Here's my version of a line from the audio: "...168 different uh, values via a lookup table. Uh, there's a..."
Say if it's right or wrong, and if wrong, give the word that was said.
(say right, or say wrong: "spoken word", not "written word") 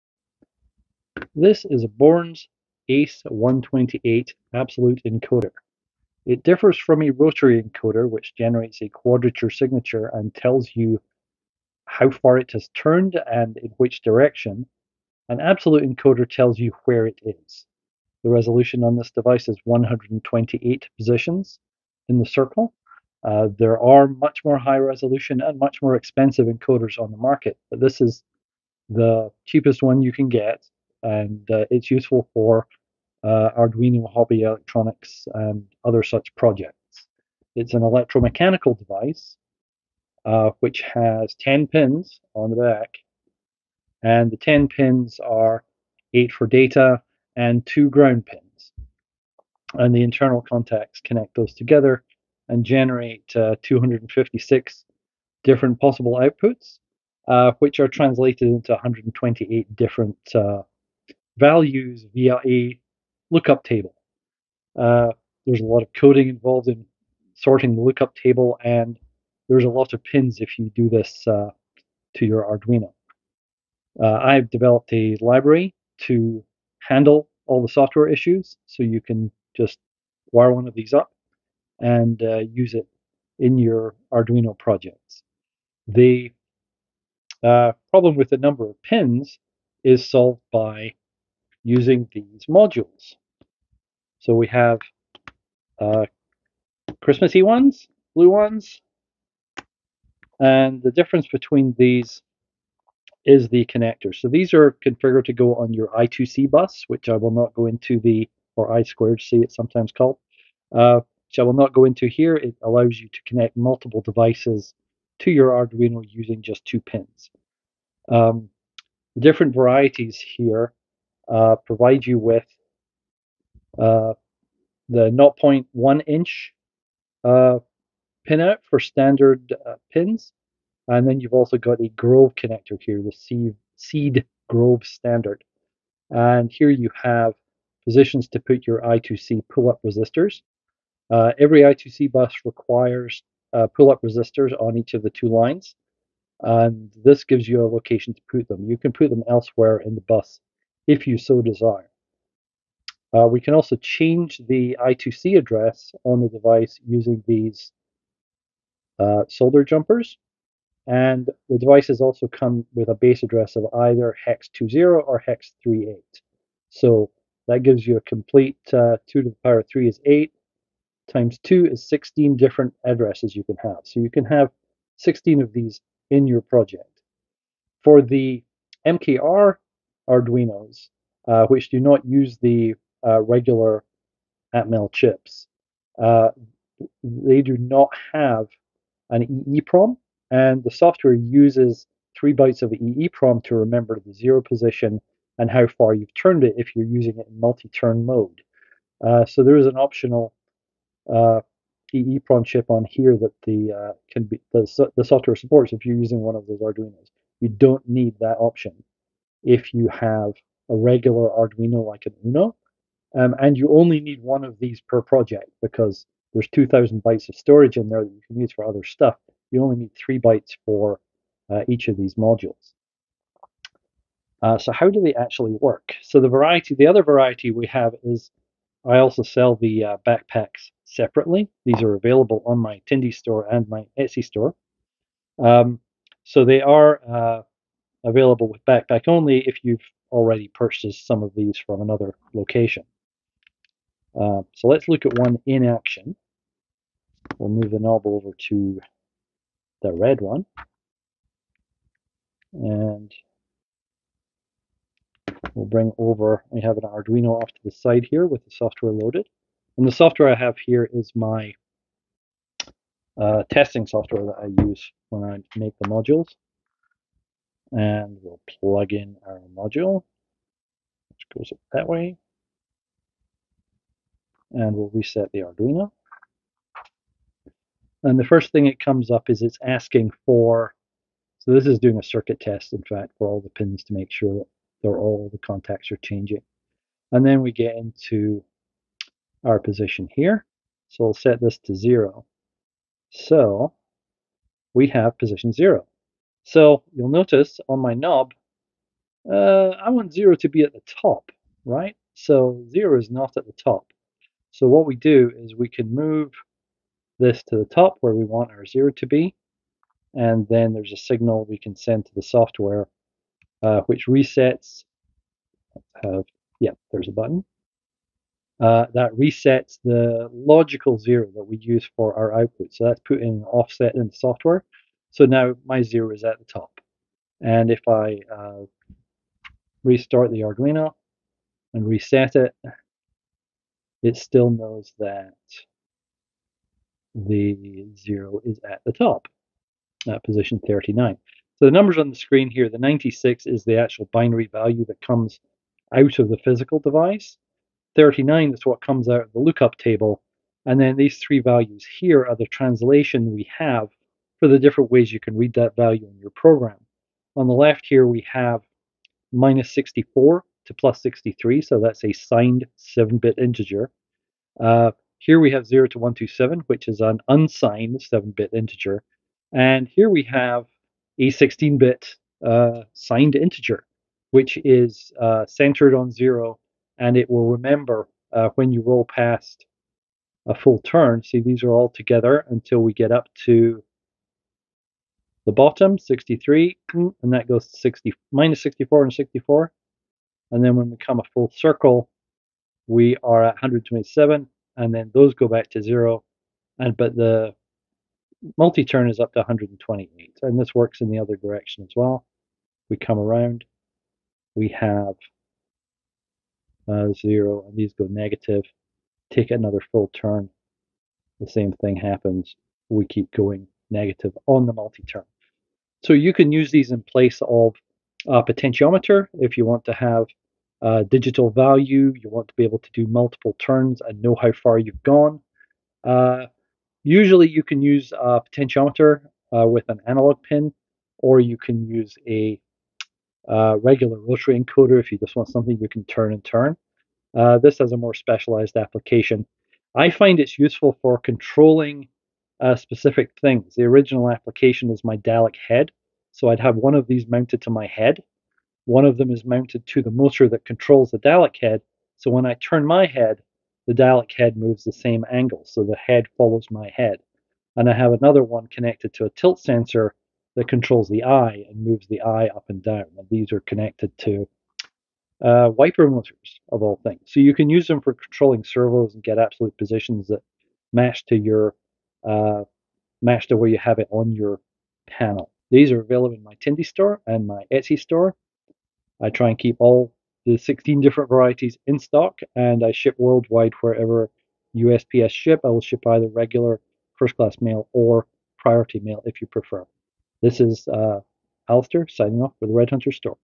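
wrong: "128", not "168".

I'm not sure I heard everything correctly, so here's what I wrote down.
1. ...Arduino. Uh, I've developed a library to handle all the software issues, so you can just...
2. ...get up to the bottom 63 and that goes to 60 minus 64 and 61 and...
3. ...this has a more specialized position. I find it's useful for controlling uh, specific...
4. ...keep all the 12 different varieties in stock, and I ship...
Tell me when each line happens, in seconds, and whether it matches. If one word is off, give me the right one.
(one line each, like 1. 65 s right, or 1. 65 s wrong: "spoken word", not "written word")
1. 72 s right
2. 382 s wrong: "64", not "61"
3. 437 s wrong: "application", not "position"
4. 479 s wrong: "16", not "12".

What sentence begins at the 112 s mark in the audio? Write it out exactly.
It allows you to connect multiple devices to your Arduino using just two pins.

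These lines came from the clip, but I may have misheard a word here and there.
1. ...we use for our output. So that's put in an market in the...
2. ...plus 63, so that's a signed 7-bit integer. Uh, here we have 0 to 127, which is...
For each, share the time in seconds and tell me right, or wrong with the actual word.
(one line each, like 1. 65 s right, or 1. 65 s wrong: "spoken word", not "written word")
1. 321 s wrong: "offset", not "market"
2. 360 s right.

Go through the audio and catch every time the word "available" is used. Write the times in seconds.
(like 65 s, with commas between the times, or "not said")
231 s, 238 s, 476 s.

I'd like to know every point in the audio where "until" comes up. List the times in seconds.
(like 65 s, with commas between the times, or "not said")
382 s.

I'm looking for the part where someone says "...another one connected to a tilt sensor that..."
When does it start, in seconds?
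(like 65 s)
458 s.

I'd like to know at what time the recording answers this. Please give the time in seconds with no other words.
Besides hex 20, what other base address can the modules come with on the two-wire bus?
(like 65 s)
165 s.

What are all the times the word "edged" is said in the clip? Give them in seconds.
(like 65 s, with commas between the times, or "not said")
not said.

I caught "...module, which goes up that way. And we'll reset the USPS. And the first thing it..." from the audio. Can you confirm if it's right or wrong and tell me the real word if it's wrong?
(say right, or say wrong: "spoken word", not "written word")
wrong: "Arduino", not "USPS".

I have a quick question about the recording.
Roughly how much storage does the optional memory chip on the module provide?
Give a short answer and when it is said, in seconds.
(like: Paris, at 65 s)
2,000 bytes, at 216 s.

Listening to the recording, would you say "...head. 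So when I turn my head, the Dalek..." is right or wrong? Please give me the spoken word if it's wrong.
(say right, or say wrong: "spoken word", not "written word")
right.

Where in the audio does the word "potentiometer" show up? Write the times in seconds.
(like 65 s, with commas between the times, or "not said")
418 s, 428 s.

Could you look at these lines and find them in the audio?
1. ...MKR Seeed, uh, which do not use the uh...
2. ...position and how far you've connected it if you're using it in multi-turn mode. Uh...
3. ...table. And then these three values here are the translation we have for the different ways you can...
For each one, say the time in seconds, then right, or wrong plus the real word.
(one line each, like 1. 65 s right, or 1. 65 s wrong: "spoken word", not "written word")
1. 178 s wrong: "Arduinos", not "Seeed"
2. 194 s wrong: "turned", not "connected"
3. 349 s right.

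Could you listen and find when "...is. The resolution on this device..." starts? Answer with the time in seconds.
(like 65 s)
17 s.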